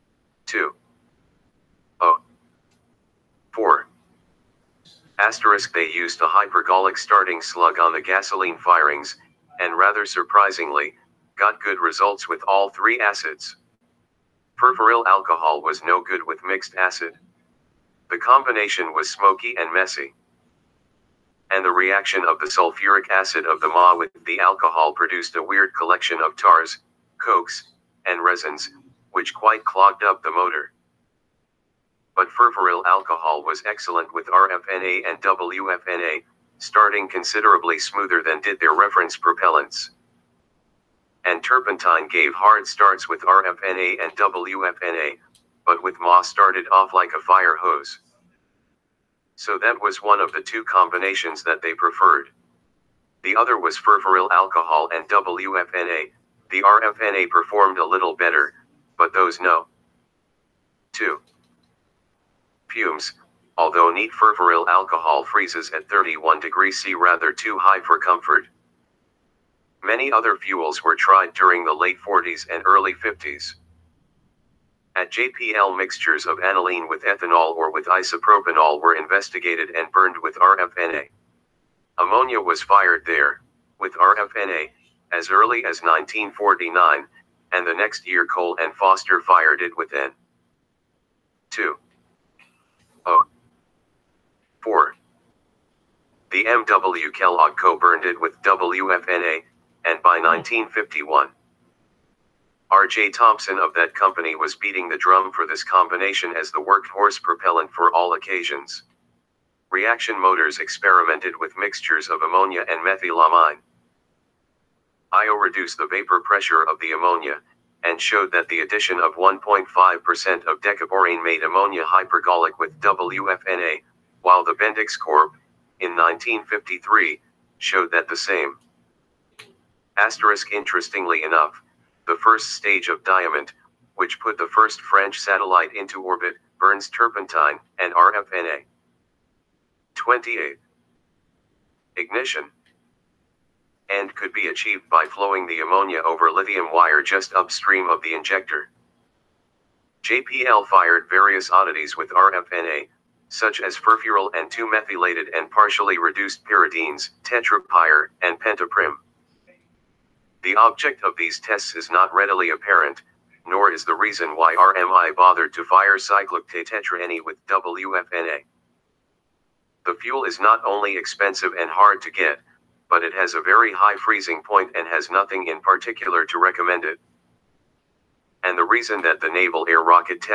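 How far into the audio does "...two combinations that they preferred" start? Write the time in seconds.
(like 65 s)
50 s.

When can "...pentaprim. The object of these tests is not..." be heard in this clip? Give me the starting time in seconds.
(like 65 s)
158 s.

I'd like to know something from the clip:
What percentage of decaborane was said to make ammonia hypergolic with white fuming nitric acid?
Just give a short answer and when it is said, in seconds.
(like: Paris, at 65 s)
1.5%, at 119 s.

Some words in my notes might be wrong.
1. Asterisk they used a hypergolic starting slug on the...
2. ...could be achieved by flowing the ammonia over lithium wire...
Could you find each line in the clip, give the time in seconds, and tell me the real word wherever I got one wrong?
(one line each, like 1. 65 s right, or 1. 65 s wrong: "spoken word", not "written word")
1. 5 s right
2. 144 s right.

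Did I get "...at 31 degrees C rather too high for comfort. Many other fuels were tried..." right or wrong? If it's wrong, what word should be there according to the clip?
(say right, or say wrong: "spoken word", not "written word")
right.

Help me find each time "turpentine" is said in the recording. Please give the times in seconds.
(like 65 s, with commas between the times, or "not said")
41 s, 136 s.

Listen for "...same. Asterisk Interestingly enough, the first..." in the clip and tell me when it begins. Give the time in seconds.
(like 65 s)
128 s.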